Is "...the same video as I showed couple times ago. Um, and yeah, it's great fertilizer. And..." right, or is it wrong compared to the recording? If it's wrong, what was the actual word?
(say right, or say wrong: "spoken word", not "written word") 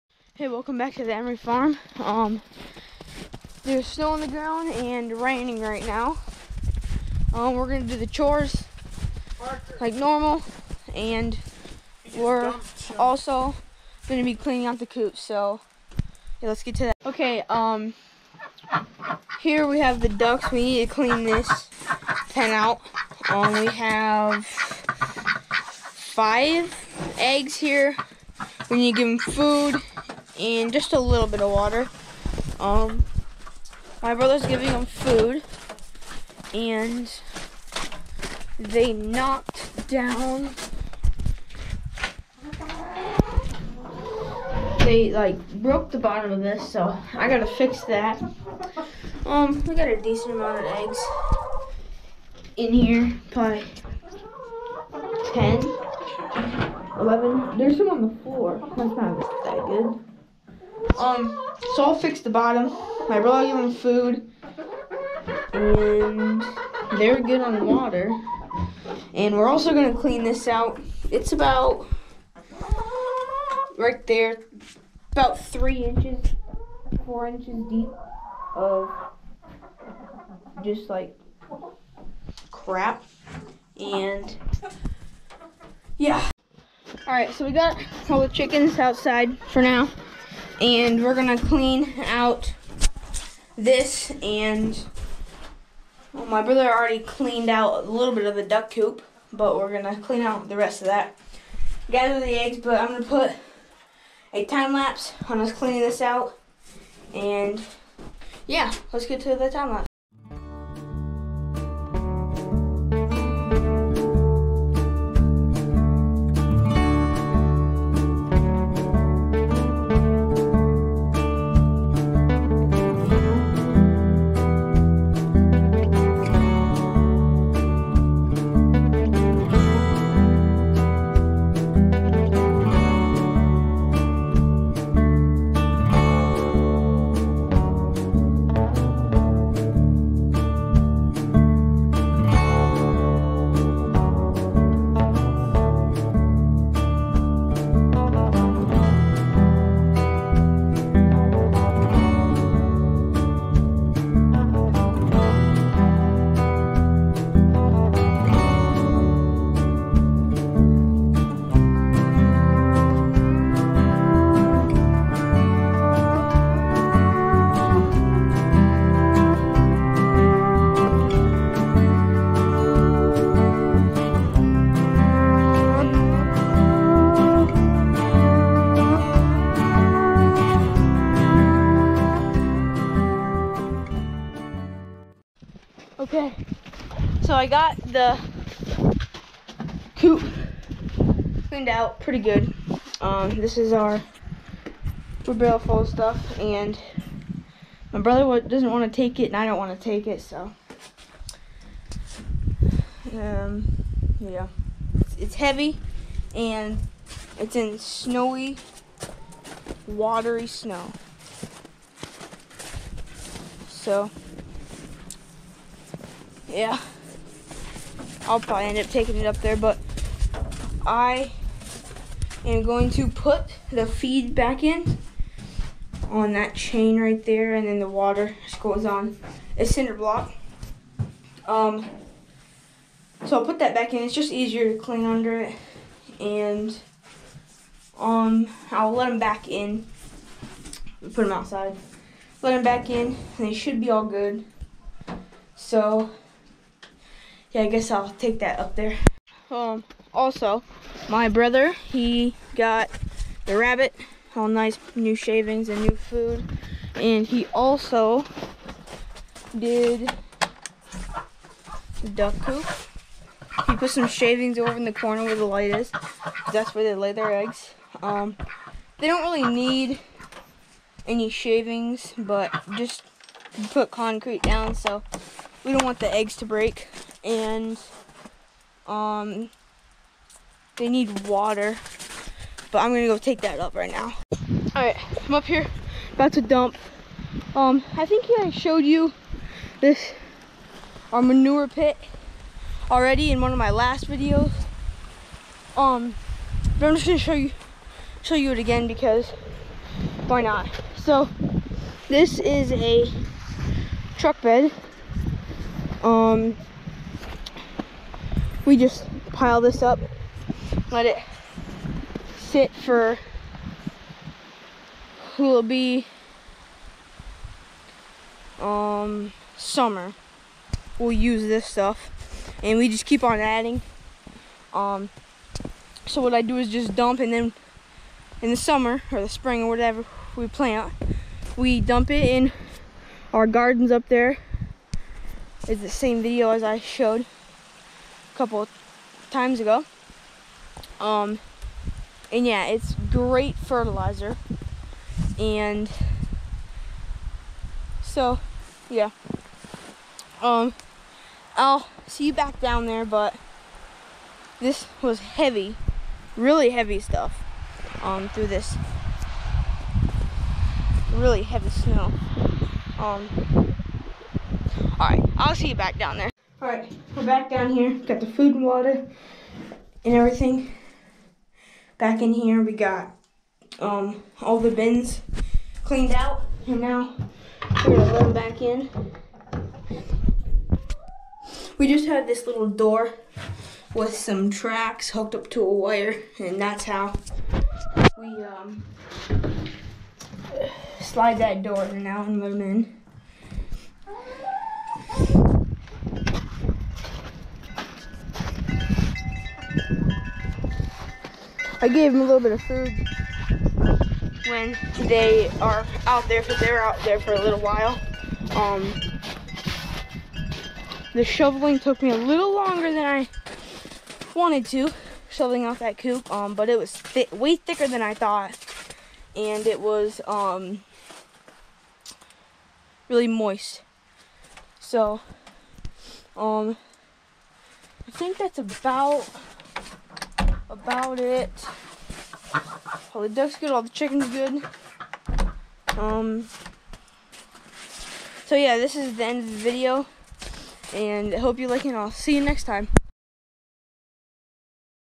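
right.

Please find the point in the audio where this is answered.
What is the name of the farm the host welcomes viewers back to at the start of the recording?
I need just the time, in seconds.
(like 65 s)
1 s.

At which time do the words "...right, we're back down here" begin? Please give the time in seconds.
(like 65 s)
366 s.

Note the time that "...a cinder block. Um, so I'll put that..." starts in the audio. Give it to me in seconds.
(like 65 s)
229 s.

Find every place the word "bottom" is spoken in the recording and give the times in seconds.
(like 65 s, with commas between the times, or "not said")
45 s, 62 s.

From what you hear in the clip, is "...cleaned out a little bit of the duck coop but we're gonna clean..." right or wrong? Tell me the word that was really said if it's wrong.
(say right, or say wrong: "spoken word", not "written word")
right.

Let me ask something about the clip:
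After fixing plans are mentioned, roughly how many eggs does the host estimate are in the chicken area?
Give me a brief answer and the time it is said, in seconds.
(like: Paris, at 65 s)
10 or 11, at 55 s.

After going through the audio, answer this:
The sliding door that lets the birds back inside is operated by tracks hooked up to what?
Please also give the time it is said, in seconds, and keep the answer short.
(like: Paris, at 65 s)
a wire, at 385 s.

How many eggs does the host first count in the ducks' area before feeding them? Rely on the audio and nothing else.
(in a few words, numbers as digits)
5.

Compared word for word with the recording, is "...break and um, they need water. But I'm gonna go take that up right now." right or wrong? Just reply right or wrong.
right.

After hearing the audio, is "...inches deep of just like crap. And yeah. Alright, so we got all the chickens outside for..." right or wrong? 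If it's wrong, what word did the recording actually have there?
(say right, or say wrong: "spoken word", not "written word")
right.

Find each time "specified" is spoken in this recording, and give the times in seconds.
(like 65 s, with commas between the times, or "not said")
not said.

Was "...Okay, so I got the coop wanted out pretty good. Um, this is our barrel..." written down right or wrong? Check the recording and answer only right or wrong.
wrong.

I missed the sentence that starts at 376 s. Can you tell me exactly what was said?
And now we're gonna let them back in.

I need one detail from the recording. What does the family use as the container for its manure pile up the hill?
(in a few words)
a truck bed.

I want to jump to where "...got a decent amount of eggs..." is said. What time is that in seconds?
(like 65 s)
49 s.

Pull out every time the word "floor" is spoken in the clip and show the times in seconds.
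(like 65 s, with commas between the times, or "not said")
58 s.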